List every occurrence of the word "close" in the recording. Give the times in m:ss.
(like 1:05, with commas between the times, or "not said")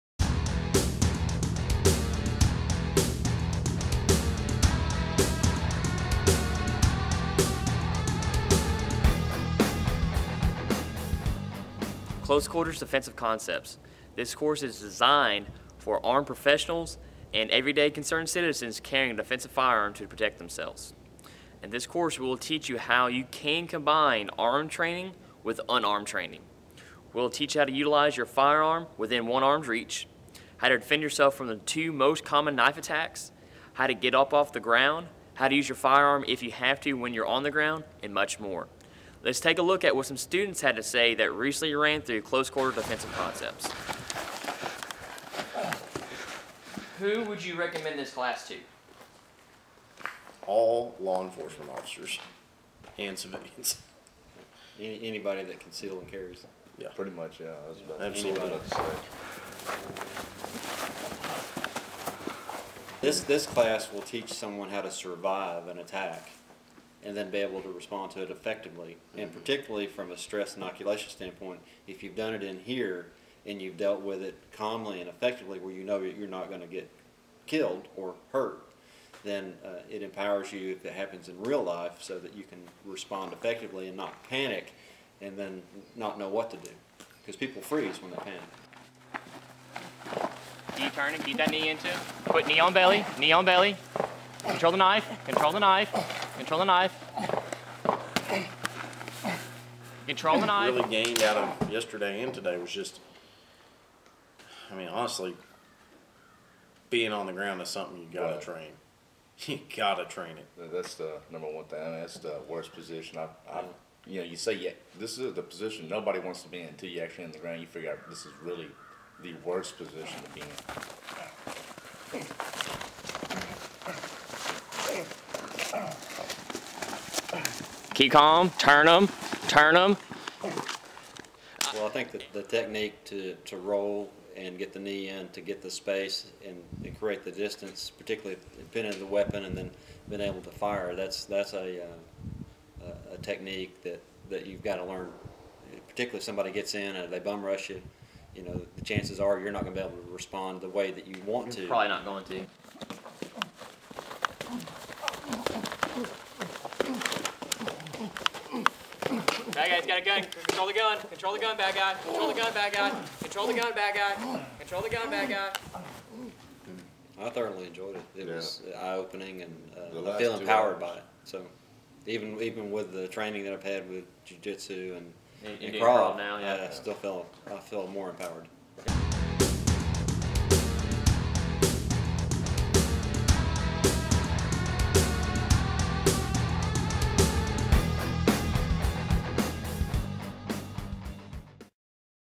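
0:12, 0:42.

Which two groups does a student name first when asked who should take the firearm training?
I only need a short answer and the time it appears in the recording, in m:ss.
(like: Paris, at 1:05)
Law enforcement officers and civilians, at 0:50.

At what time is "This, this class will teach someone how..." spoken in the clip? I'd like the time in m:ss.
1:03.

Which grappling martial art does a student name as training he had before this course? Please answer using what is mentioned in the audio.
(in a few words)
Jujitsu.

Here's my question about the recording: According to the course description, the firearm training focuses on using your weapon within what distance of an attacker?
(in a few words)
One arm's reach.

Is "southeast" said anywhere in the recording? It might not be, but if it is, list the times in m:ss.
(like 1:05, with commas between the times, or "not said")
not said.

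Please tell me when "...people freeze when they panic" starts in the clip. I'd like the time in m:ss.
1:27.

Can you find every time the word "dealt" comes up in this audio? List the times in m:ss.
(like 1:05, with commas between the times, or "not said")
1:13.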